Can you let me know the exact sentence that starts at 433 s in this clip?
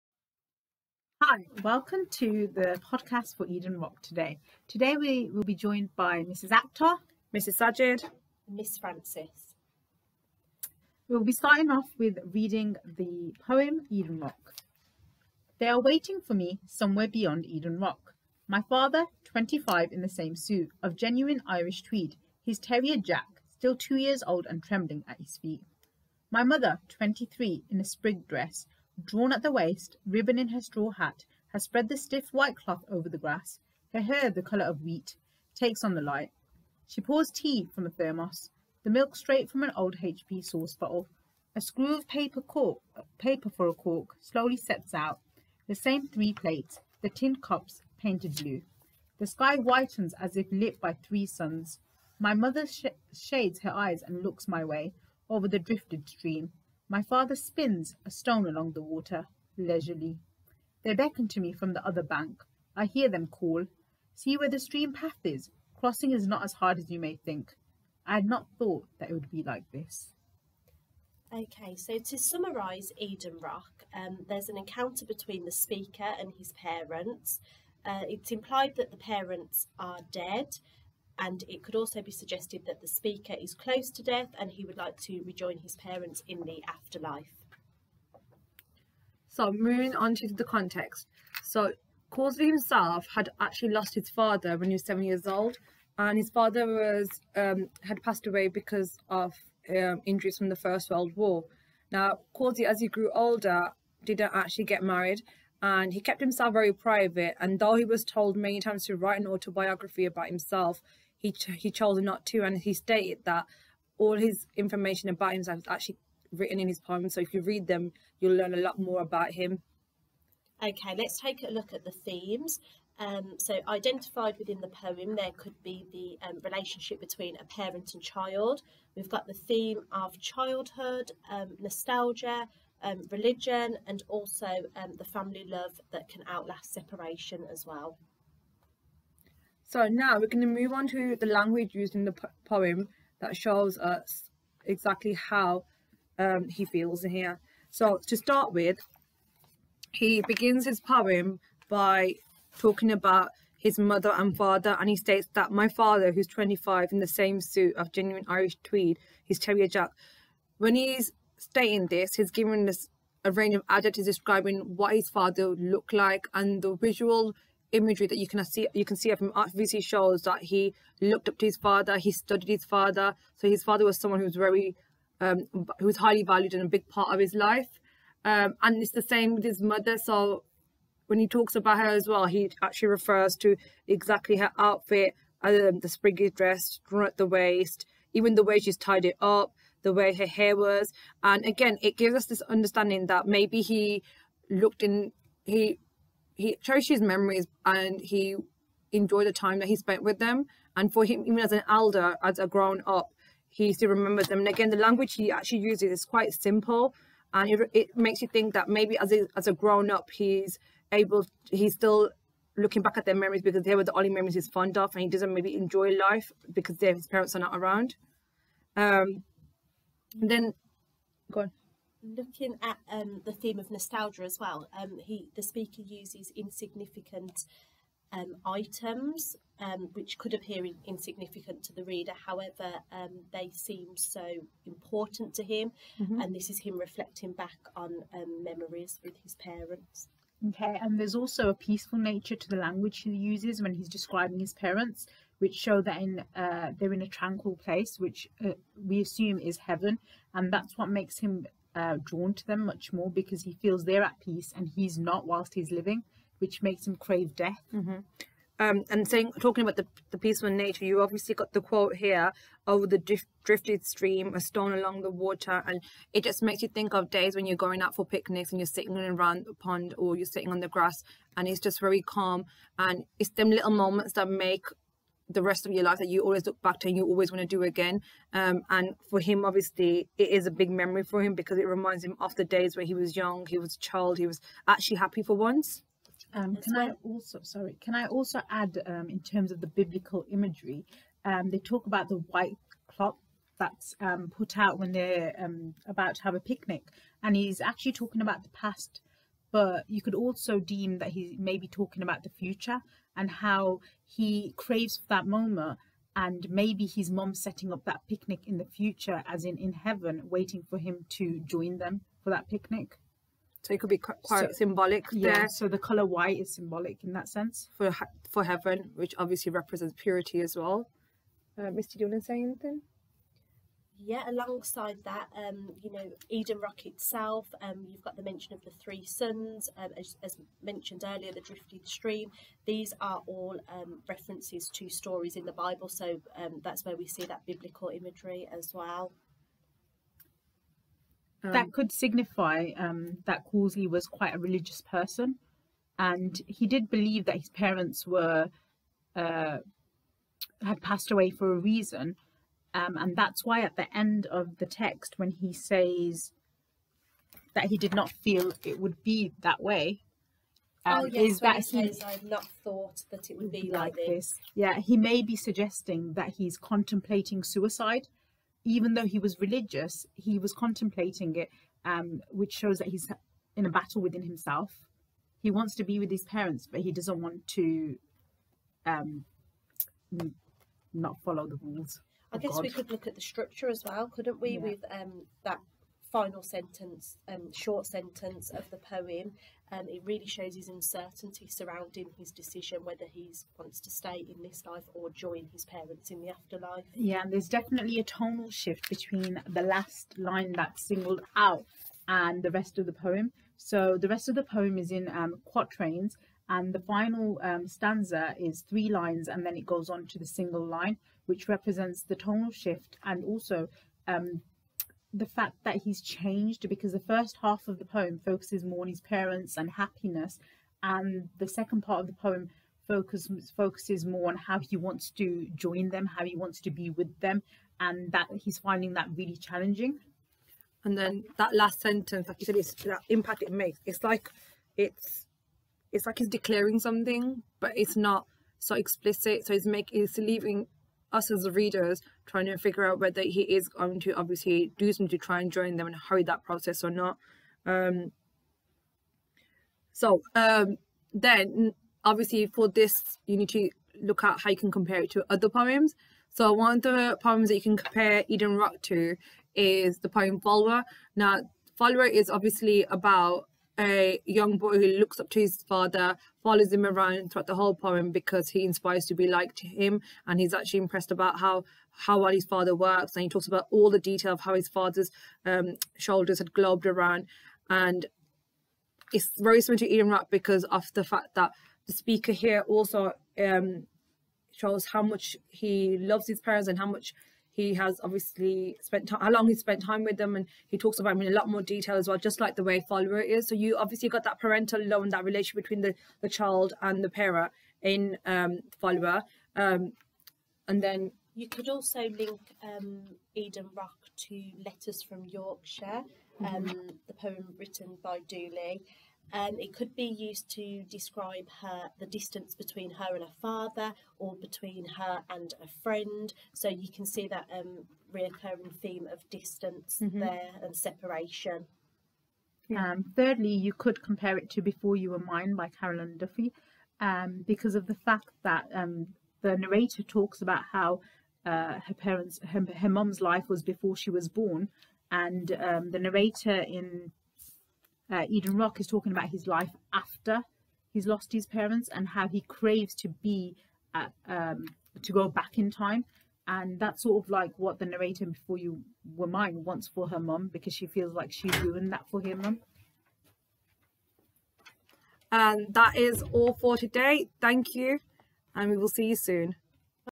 It's like it's it's like he's declaring something, but it's not so explicit.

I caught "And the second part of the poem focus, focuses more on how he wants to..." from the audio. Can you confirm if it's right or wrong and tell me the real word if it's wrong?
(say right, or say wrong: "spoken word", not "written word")
right.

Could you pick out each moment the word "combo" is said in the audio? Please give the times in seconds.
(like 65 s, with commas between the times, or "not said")
not said.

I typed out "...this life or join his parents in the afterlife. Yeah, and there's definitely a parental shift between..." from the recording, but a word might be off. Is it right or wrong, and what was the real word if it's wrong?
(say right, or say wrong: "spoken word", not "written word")
wrong: "tonal", not "parental".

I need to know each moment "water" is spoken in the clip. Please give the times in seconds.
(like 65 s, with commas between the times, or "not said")
58 s, 265 s.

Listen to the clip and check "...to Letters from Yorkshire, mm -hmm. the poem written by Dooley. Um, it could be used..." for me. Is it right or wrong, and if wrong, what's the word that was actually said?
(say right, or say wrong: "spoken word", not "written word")
right.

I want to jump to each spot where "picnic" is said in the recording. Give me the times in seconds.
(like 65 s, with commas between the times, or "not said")
268 s, 296 s, 308 s, 312 s.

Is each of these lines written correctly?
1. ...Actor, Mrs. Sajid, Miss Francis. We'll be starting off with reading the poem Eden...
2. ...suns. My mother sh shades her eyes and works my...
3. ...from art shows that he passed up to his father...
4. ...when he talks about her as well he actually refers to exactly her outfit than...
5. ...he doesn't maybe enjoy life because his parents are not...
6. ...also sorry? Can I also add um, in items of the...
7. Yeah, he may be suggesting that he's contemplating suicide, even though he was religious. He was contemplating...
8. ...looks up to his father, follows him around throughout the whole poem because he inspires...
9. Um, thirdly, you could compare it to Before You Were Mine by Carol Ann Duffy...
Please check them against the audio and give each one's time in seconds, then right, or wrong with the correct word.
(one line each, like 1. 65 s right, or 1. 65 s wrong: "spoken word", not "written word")
1. 6 s right
2. 51 s wrong: "looks", not "works"
3. 169 s wrong: "looked", not "passed"
4. 181 s right
5. 215 s right
6. 287 s wrong: "terms", not "items"
7. 364 s right
8. 464 s right
9. 522 s right.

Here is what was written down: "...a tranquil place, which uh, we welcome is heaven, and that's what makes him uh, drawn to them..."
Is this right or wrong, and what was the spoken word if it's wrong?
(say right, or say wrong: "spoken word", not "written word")
wrong: "assume", not "welcome".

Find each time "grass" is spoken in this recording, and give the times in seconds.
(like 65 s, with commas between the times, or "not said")
33 s, 270 s.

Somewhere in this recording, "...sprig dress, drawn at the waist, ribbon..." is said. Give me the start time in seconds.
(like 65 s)
27 s.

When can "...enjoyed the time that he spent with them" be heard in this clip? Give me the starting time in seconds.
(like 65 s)
198 s.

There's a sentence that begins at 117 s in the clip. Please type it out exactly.
So if you read them, you'll learn a lot more about him.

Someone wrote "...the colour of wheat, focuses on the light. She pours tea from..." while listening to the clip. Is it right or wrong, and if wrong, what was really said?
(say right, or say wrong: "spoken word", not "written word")
wrong: "takes", not "focuses".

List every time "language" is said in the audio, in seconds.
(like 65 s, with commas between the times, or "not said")
141 s, 204 s, 242 s.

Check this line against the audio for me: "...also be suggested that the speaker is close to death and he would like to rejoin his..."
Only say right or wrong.
right.